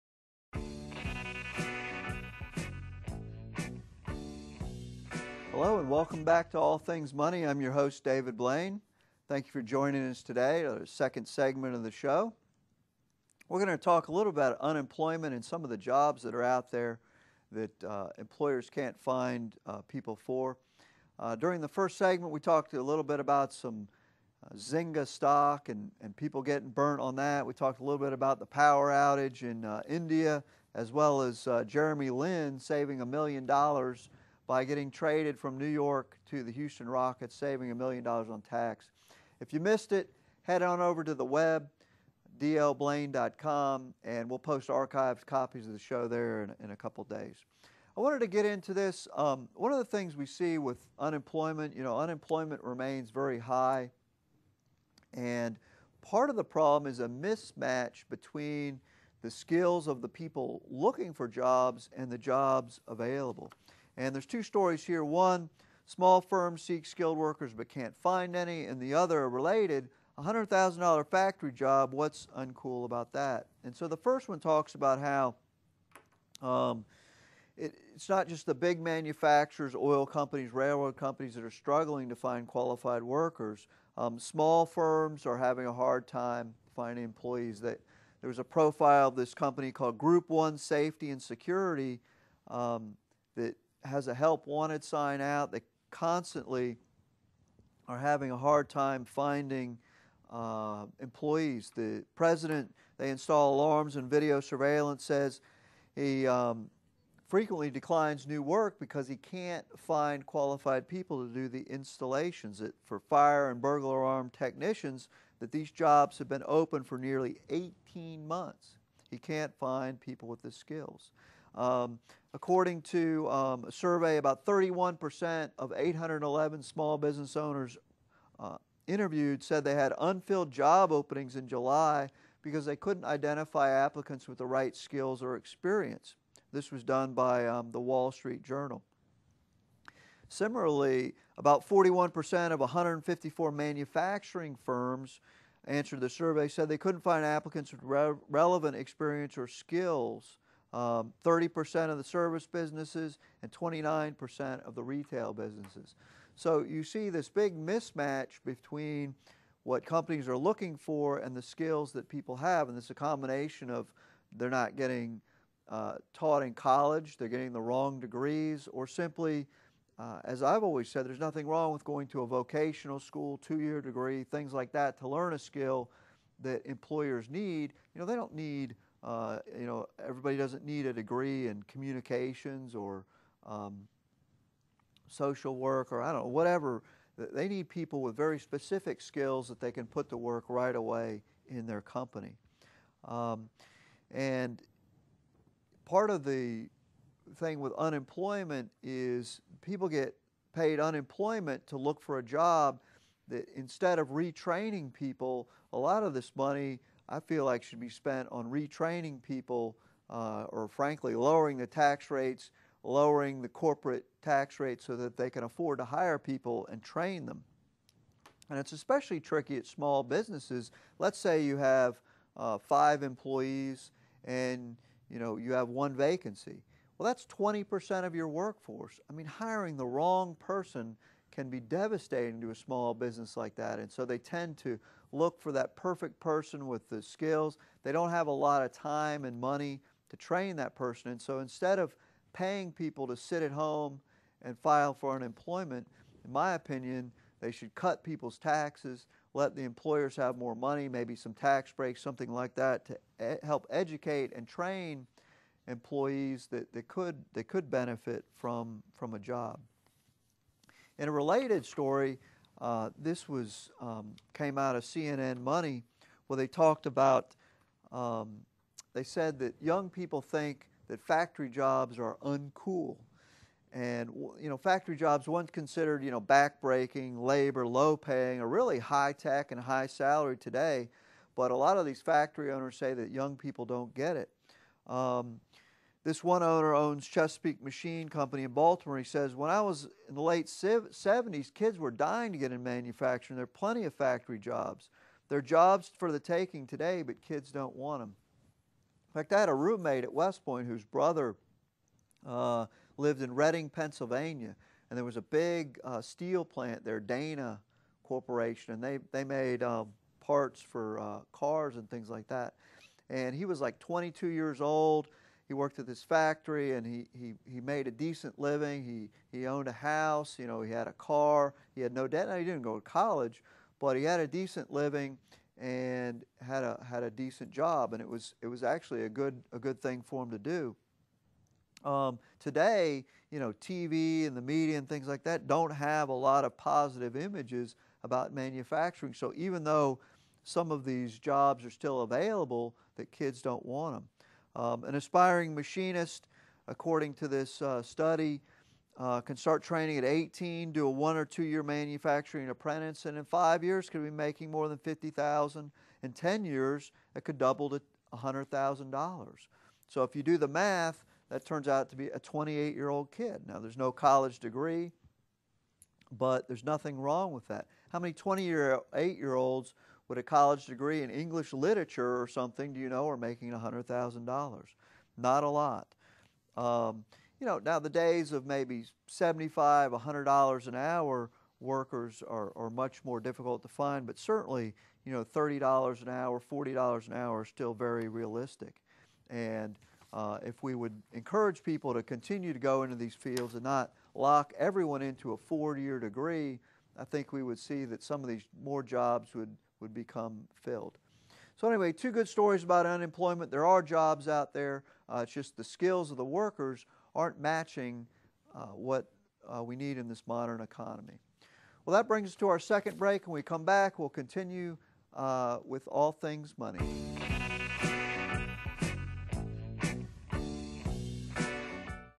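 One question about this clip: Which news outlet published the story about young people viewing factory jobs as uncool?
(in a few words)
CNN Money.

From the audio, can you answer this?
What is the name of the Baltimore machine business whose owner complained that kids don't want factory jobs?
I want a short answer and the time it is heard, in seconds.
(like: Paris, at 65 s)
Chesapeake Machine Company, at 287 s.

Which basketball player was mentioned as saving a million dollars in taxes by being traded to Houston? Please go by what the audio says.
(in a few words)
Jeremy Lin.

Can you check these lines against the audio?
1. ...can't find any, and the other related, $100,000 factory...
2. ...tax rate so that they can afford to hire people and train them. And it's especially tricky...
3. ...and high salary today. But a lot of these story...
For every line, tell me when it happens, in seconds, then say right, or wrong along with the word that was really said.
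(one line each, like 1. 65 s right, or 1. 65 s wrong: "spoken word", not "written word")
1. 67 s right
2. 214 s right
3. 279 s wrong: "factory", not "story".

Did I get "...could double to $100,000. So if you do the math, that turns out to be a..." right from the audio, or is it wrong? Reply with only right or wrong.
right.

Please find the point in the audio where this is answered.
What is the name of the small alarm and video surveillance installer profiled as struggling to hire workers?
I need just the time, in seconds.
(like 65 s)
89 s.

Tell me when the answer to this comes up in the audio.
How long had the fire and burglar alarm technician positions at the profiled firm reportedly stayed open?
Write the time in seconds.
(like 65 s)
116 s.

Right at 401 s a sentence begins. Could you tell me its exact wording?
So, anyway, two good stories about unemployment.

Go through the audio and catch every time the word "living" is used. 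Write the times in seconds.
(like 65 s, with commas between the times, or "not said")
318 s, 324 s.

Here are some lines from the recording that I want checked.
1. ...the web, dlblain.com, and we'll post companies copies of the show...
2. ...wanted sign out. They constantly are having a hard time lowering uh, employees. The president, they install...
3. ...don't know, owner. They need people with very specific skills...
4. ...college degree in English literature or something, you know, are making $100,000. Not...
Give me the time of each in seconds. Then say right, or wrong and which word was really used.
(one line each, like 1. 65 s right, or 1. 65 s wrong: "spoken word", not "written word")
1. 41 s wrong: "archives", not "companies"
2. 94 s wrong: "finding", not "lowering"
3. 186 s wrong: "whatever", not "owner"
4. 370 s right.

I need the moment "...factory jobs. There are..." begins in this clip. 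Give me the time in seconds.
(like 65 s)
293 s.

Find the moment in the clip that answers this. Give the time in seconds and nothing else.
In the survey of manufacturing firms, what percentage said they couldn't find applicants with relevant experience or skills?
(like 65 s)
141 s.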